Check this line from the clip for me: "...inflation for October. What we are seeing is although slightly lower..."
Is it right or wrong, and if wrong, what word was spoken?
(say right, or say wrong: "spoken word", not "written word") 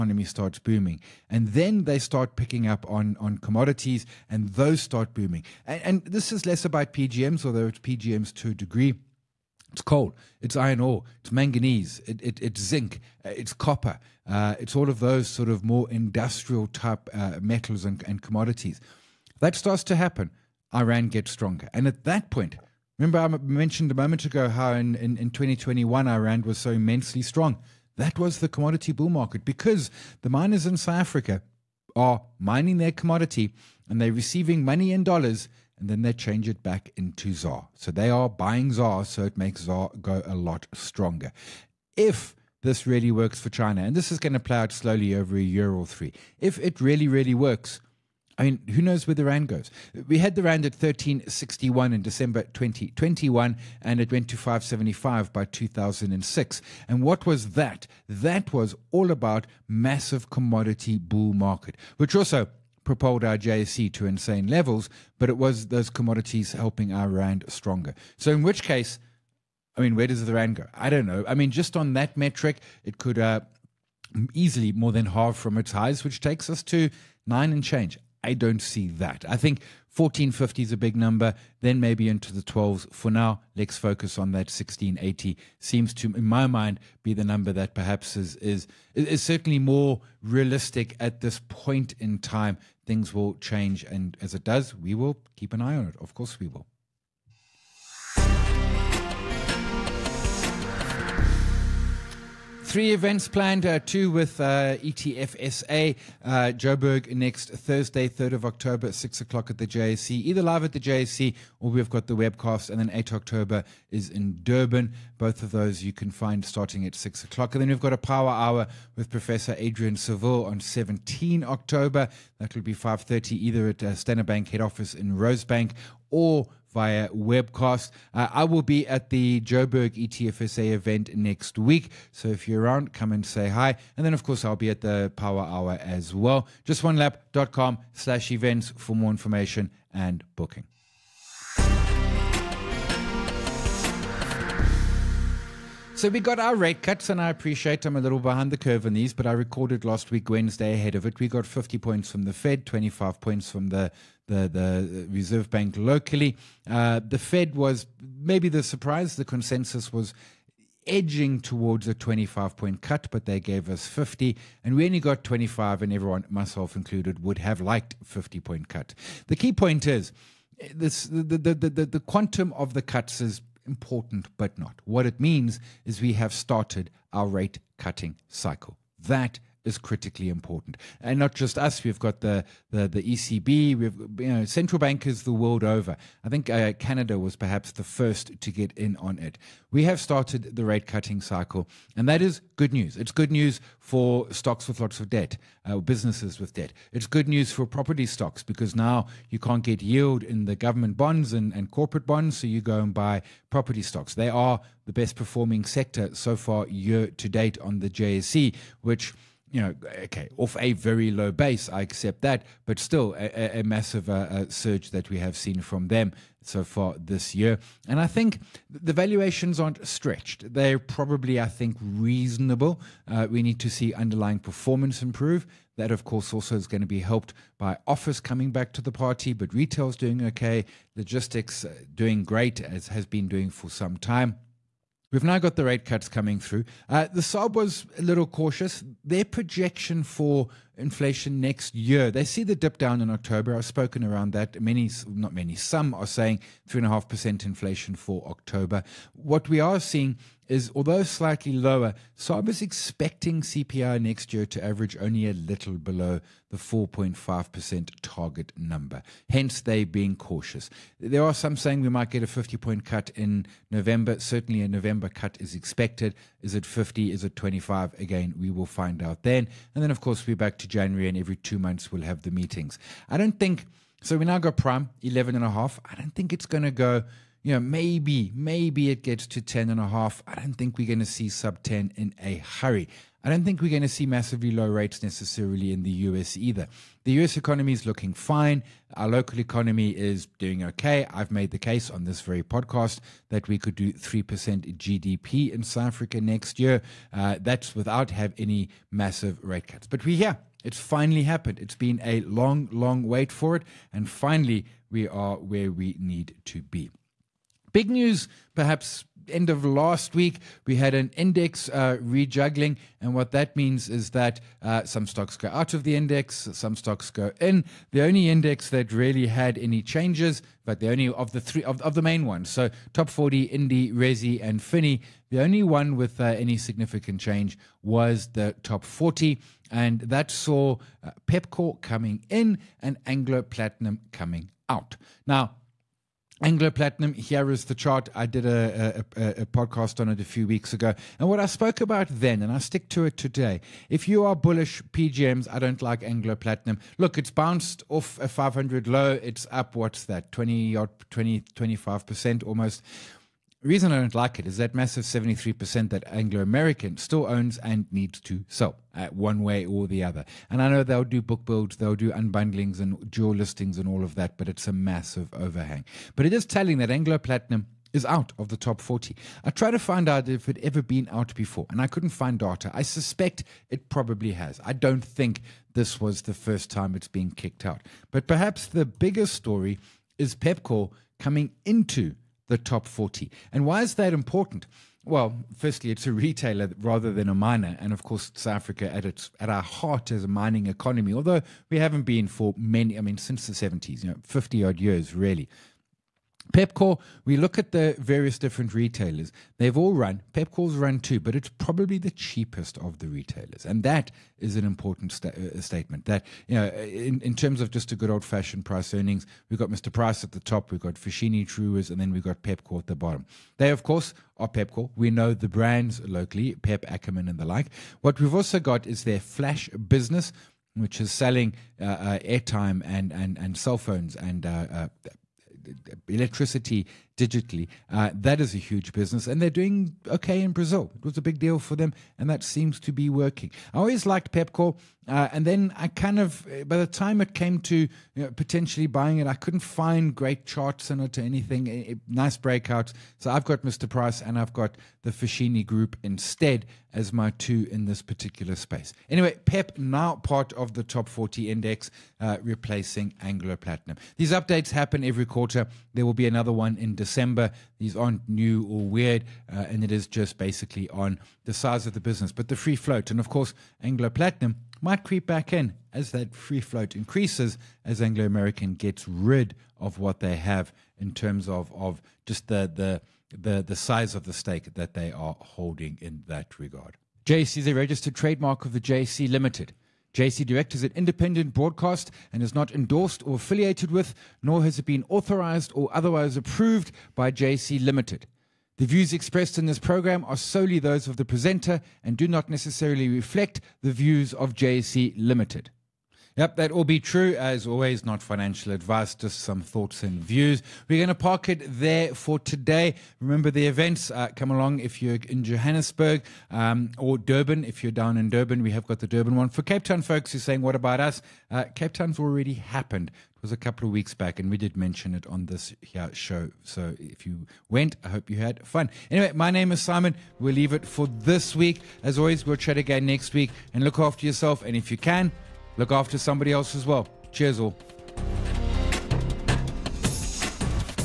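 right.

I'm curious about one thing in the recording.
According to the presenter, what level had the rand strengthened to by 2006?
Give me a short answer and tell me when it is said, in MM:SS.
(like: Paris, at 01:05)
5.75, at 00:54.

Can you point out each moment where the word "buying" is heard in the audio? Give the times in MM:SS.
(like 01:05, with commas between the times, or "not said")
00:38, 07:18.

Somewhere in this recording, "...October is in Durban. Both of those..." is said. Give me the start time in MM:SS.
01:53.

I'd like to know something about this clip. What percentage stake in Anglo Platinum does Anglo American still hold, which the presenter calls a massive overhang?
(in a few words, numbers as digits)
73%.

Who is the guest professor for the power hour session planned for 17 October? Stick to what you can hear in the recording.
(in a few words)
Adrian Saville.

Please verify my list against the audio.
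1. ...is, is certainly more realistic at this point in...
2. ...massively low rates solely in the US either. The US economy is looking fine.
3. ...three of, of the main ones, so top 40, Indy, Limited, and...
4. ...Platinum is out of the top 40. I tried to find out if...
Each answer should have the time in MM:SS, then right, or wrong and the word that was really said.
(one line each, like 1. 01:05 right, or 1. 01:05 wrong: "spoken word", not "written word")
1. 01:28 right
2. 04:44 wrong: "necessarily", not "solely"
3. 05:21 wrong: "Resi", not "Limited"
4. 06:07 right.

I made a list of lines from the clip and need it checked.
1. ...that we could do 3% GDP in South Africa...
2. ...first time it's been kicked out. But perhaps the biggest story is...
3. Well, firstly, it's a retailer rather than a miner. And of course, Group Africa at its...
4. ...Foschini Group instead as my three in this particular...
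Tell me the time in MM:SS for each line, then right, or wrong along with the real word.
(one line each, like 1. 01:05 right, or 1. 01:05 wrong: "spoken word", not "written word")
1. 04:53 right
2. 06:16 right
3. 06:25 wrong: "South", not "Group"
4. 07:25 wrong: "two", not "three".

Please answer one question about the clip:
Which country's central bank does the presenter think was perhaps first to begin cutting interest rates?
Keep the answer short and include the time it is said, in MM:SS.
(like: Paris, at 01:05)
Canada, at 03:06.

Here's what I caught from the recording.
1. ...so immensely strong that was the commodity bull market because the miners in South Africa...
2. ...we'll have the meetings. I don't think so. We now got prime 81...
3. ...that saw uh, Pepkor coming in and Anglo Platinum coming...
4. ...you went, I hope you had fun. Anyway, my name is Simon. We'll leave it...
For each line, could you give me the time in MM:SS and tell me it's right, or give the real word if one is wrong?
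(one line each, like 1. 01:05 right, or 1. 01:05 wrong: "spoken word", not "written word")
1. 00:26 right
2. 04:31 wrong: "11", not "81"
3. 05:30 right
4. 08:37 right.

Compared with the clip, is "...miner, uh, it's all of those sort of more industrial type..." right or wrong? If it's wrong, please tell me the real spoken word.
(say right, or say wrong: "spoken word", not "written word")
wrong: "copper", not "miner".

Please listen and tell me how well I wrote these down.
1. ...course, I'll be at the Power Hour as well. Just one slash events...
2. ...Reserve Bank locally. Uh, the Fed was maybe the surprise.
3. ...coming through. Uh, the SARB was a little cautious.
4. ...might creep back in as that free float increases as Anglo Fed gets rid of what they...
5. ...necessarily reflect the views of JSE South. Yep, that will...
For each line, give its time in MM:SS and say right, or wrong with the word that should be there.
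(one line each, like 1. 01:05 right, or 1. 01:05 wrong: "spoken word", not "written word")
1. 02:14 right
2. 02:35 right
3. 03:56 right
4. 07:44 wrong: "American", not "Fed"
5. 08:12 wrong: "Limited", not "South".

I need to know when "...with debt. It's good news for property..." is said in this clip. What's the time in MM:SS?
03:16.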